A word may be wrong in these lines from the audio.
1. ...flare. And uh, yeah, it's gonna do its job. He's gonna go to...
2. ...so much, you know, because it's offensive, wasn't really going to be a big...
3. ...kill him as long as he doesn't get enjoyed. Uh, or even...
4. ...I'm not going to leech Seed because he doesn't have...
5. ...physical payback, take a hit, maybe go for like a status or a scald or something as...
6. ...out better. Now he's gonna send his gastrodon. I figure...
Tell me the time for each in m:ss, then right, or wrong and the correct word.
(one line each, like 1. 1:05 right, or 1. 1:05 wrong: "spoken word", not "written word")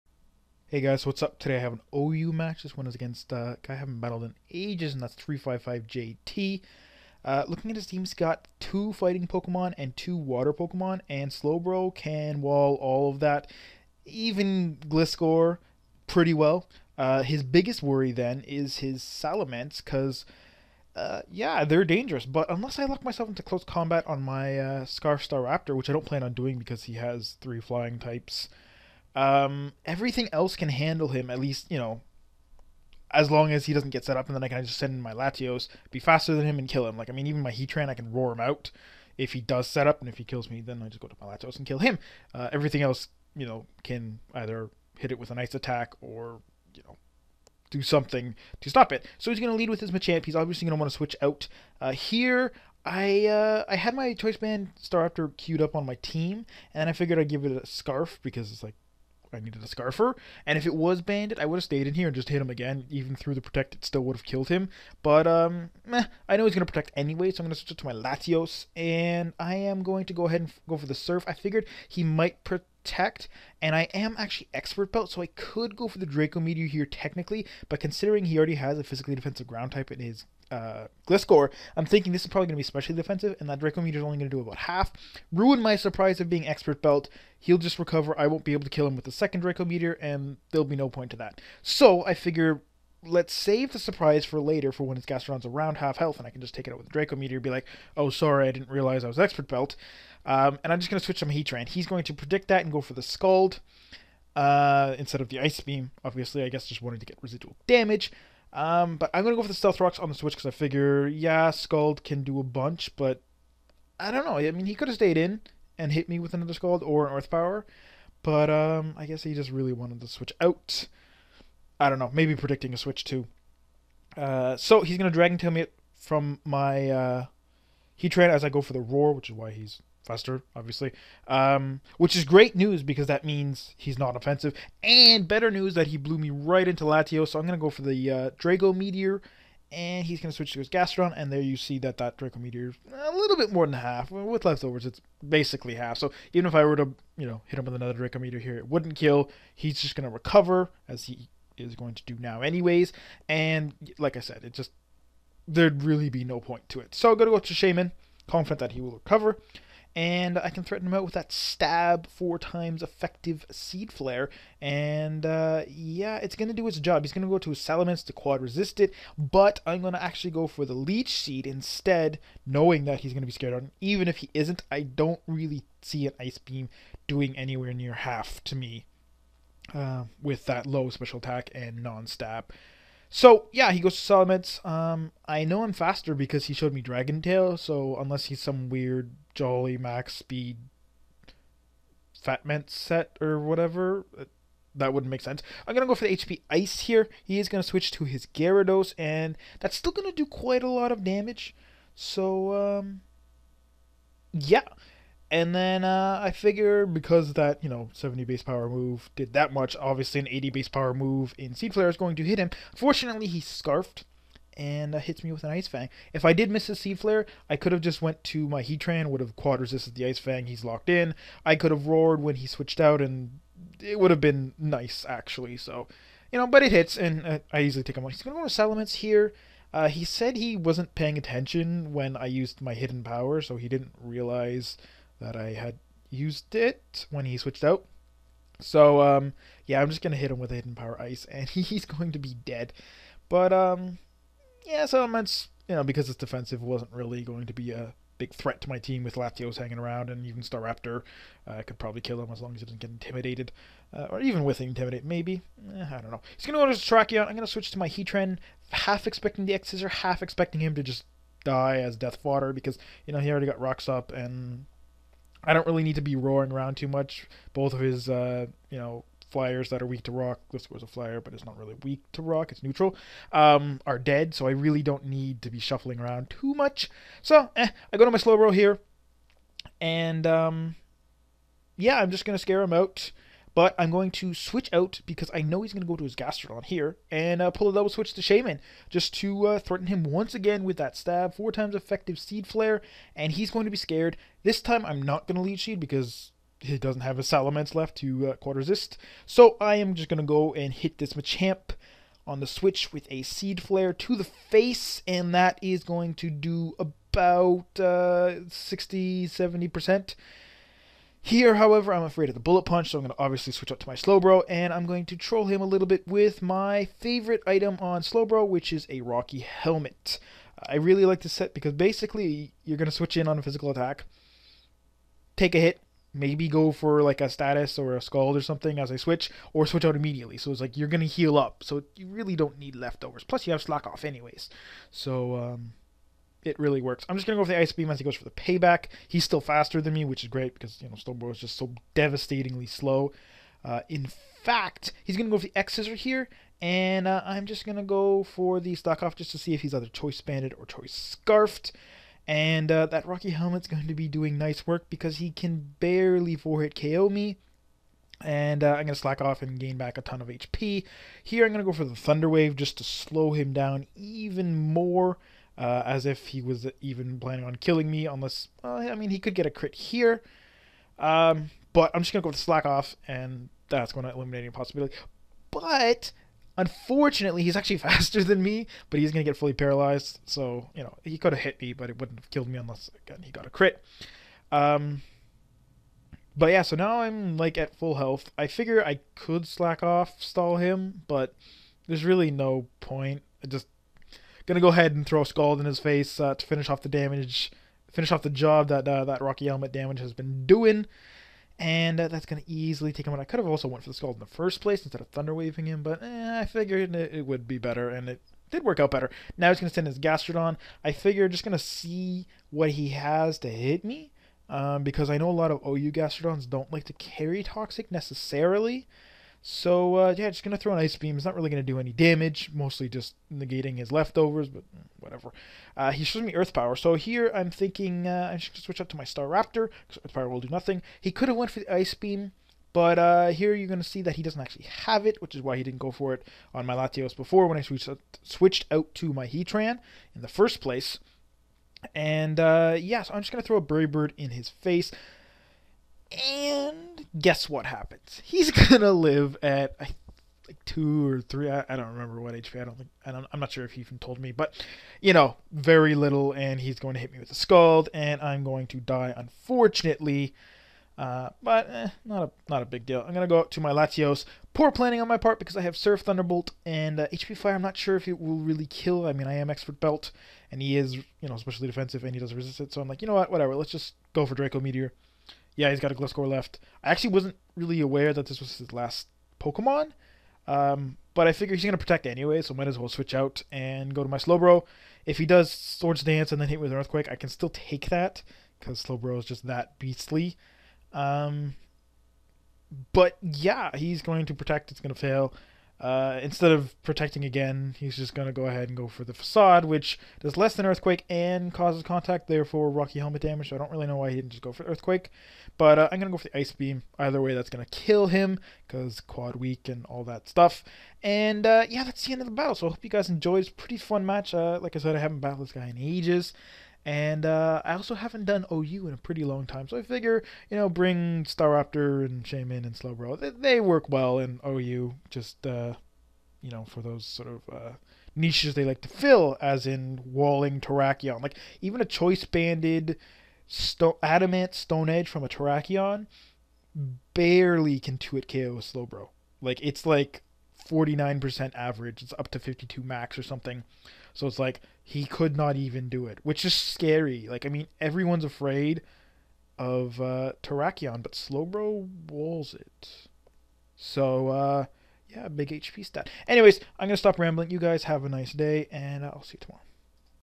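1. 2:43 right
2. 4:04 wrong: "defensive", not "offensive"
3. 4:12 wrong: "intimidated", not "enjoyed"
4. 4:54 right
5. 5:23 wrong: "attack", not "payback"
6. 6:48 right.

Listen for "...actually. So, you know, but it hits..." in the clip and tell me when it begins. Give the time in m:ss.
3:45.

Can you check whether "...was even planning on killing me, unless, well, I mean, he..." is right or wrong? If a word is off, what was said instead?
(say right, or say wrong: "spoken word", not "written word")
right.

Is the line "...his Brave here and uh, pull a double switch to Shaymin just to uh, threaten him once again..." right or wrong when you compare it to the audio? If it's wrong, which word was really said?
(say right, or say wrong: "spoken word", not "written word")
wrong: "Gastrodon", not "Brave".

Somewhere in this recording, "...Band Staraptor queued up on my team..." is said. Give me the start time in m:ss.
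0:54.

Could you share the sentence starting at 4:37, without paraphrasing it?
So, eh, I go to my Slowbro here, and um, yeah, I'm just going to scare him out.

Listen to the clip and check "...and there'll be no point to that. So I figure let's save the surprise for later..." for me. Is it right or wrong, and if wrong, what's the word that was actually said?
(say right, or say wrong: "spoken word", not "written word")
right.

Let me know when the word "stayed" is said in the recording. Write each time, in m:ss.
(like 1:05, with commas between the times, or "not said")
1:01, 1:54.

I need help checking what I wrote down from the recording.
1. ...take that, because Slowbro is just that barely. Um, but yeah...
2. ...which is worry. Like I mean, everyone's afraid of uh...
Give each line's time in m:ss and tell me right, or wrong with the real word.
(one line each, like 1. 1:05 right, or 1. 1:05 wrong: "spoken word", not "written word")
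1. 8:07 wrong: "beastly", not "barely"
2. 9:06 wrong: "scary", not "worry".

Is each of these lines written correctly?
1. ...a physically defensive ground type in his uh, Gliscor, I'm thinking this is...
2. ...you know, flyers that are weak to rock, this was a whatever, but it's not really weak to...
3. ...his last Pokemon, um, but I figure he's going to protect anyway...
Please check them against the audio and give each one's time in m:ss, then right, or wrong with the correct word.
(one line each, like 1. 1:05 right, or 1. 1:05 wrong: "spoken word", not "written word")
1. 1:18 right
2. 4:28 wrong: "flyer", not "whatever"
3. 7:58 right.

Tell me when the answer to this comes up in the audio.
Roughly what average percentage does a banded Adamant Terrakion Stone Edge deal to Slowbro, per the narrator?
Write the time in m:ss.
9:00.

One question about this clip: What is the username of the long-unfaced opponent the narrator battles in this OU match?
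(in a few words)
355JT.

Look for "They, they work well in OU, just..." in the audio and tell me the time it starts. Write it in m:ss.
8:43.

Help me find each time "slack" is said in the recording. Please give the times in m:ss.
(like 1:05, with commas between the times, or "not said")
5:33, 5:48, 5:58, 6:12, 6:29.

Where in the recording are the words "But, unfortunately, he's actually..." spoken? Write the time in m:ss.
6:15.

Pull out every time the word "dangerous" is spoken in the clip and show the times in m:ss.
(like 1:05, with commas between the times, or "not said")
0:21.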